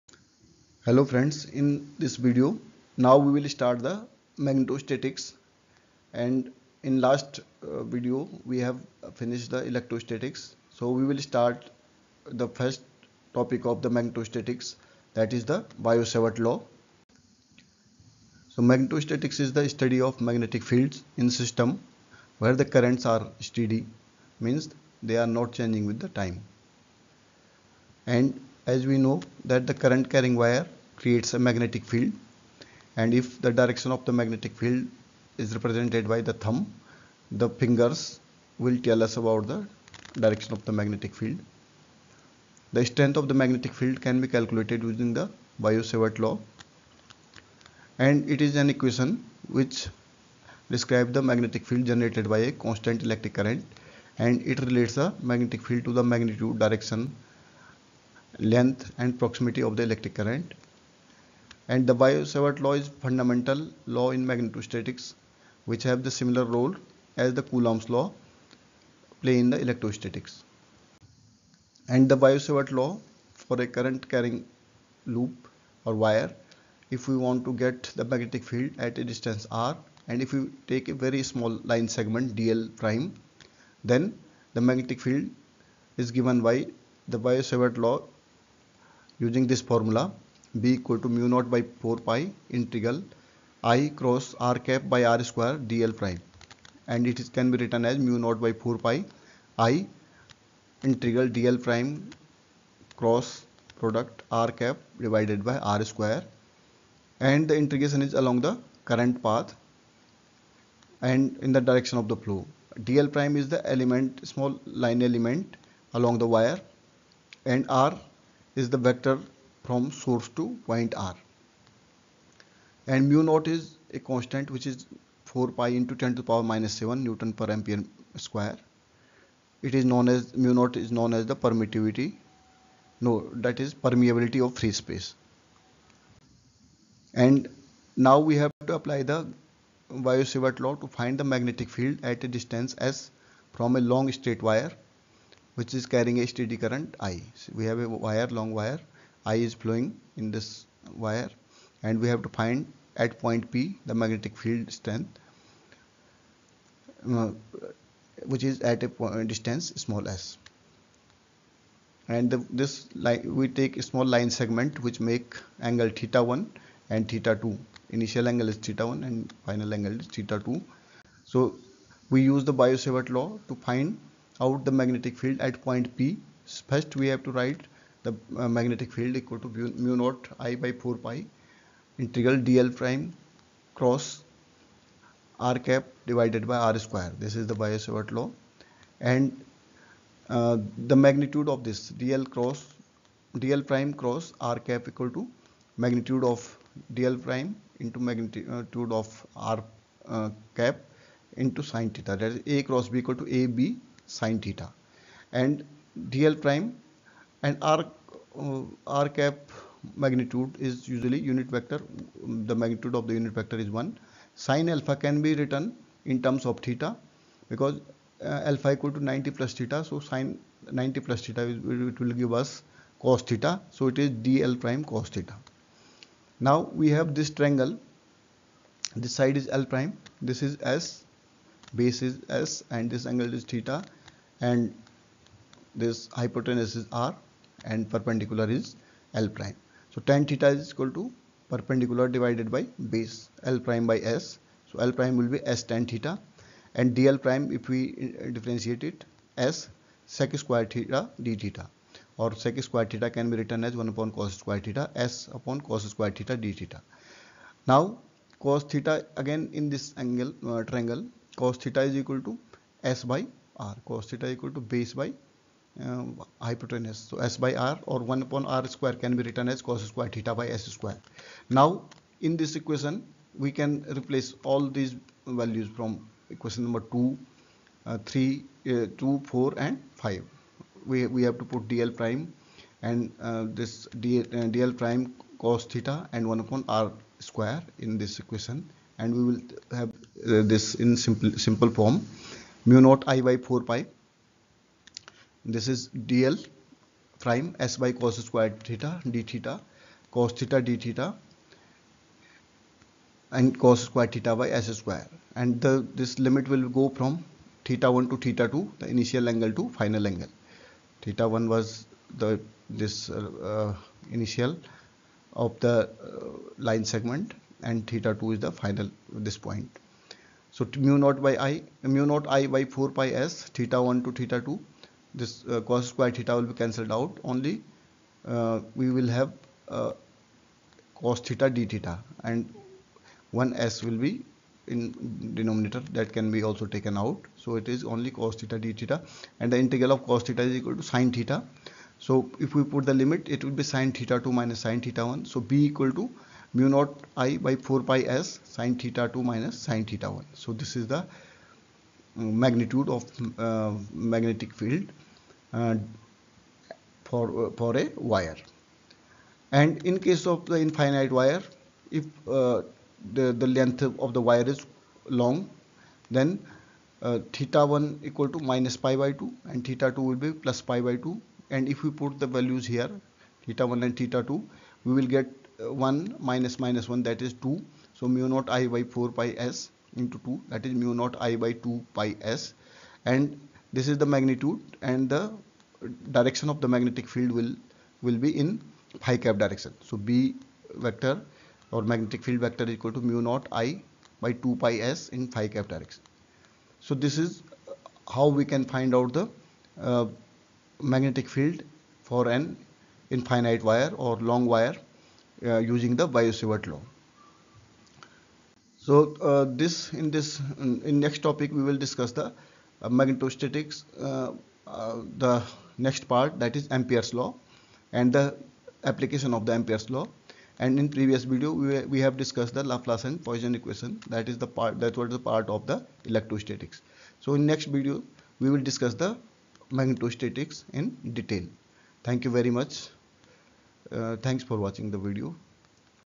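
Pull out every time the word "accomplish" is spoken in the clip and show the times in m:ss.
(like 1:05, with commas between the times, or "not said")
not said.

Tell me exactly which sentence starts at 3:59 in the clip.
So tan theta is equal to perpendicular divided by base l prime by s.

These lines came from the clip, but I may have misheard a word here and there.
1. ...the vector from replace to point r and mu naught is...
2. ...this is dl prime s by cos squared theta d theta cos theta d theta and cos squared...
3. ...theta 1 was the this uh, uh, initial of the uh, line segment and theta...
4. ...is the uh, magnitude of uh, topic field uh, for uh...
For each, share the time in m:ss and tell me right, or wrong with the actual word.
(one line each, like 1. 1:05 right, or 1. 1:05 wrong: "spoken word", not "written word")
1. 1:58 wrong: "source", not "replace"
2. 4:55 right
3. 5:11 right
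4. 5:50 wrong: "magnetic", not "topic".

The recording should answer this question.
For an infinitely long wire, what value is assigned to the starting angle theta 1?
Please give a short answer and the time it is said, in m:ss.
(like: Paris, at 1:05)
Minus pi by 2, at 6:08.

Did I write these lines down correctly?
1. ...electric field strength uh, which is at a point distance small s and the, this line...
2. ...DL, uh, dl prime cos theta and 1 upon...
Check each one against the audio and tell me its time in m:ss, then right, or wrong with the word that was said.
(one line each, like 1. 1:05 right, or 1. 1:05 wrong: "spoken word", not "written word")
1. 2:33 wrong: "magnetic", not "electric"
2. 4:44 right.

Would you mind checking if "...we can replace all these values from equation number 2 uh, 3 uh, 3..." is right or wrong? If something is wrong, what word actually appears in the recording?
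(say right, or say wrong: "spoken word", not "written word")
wrong: "2", not "3".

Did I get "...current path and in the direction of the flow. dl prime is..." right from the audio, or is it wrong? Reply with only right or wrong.
right.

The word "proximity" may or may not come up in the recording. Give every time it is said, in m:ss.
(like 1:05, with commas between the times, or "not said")
0:59.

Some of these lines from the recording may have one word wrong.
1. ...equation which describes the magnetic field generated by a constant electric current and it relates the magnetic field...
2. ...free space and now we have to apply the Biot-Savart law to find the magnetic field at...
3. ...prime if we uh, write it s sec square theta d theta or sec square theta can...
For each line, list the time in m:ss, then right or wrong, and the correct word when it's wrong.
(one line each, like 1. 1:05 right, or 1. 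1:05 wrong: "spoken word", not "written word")
1. 0:48 right
2. 2:14 right
3. 4:07 wrong: "differentiate", not "write".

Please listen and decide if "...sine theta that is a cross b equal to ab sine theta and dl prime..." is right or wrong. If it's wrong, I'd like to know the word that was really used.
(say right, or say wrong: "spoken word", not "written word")
right.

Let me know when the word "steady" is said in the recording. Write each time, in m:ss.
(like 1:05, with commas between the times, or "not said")
0:23, 2:26.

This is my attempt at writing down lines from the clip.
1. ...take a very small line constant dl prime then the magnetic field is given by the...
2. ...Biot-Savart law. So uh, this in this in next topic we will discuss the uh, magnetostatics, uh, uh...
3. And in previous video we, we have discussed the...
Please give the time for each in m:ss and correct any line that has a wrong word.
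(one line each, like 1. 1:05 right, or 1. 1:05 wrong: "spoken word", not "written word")
1. 1:20 wrong: "segment", not "constant"
2. 6:46 right
3. 7:00 right.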